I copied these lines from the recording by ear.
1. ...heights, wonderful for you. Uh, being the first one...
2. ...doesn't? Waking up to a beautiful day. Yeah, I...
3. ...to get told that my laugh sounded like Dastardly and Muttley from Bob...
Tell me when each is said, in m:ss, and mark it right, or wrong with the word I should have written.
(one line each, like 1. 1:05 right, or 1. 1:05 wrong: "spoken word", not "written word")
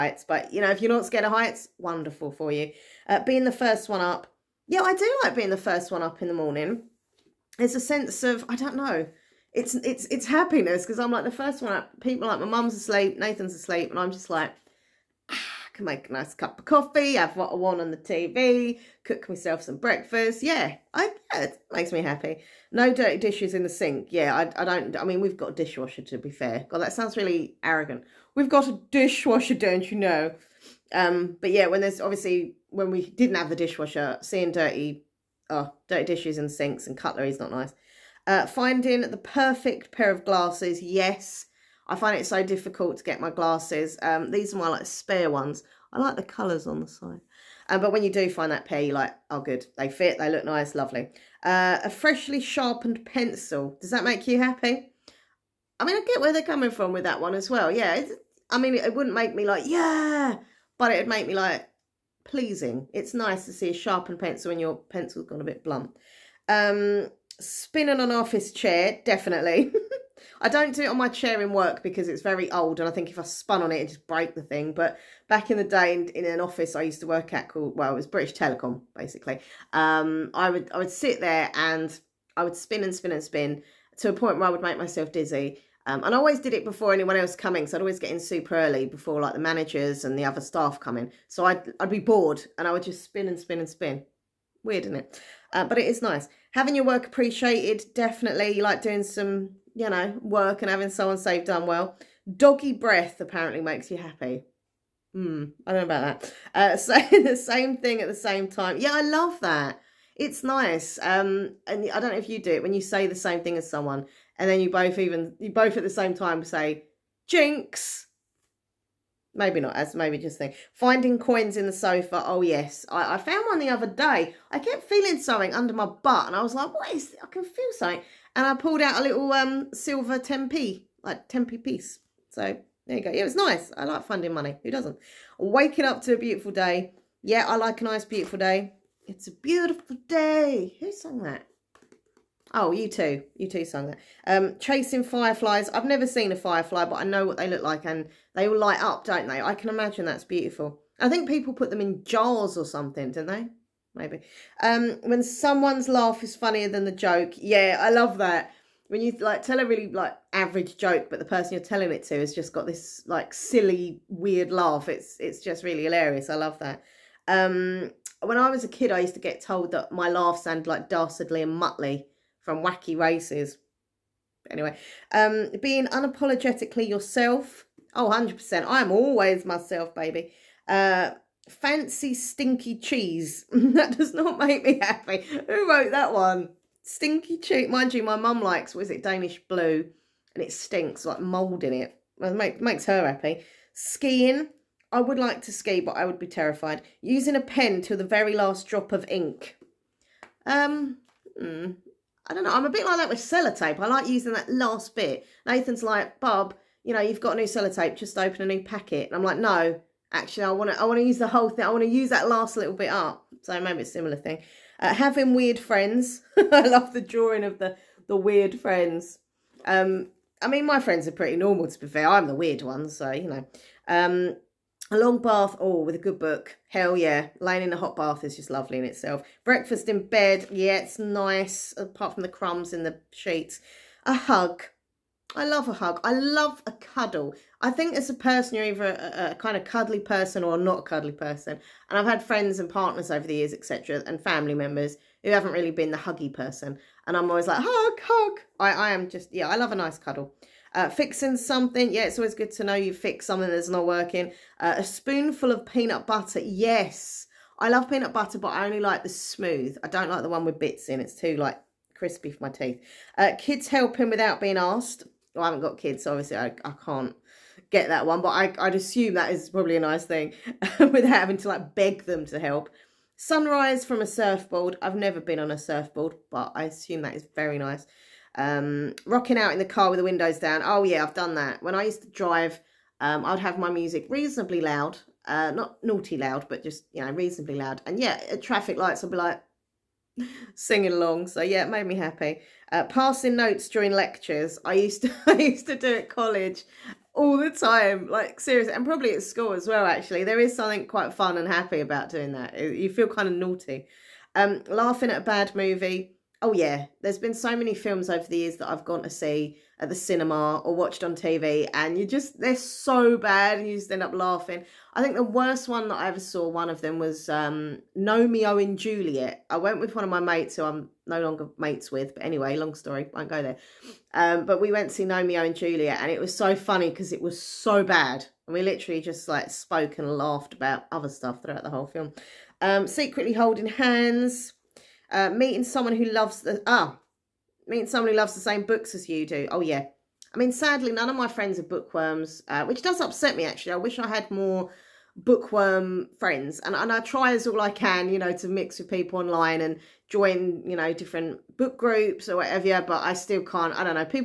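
1. 0:01 right
2. 2:14 right
3. 2:49 wrong: "Wacky", not "Bob".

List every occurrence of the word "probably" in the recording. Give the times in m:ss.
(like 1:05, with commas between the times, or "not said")
4:29, 4:58.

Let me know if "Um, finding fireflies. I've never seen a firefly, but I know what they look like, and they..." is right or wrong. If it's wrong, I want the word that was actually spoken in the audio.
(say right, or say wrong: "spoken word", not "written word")
wrong: "chasing", not "finding".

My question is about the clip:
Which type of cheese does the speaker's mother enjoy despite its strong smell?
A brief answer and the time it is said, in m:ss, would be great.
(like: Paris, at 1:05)
Danish blue, at 3:09.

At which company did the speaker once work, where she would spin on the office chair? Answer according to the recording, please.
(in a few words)
British Telecom.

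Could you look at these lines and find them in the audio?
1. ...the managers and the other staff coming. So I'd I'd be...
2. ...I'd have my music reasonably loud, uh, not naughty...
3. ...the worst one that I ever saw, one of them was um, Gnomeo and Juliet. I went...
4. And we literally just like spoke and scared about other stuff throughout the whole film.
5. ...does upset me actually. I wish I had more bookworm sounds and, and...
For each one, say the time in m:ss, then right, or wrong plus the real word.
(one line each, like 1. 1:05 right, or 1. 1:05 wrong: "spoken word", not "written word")
1. 1:29 right
2. 4:43 right
3. 5:15 right
4. 5:28 wrong: "laughed", not "scared"
5. 5:42 wrong: "friends", not "sounds".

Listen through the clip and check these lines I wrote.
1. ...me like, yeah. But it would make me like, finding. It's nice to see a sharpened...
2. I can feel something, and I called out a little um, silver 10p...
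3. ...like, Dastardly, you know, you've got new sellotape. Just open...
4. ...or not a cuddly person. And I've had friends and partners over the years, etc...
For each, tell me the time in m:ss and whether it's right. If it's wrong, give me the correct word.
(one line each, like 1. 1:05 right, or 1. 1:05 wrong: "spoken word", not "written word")
1. 0:59 wrong: "pleasing", not "finding"
2. 2:07 wrong: "pulled", not "called"
3. 3:25 wrong: "Bob", not "Dastardly"
4. 4:00 right.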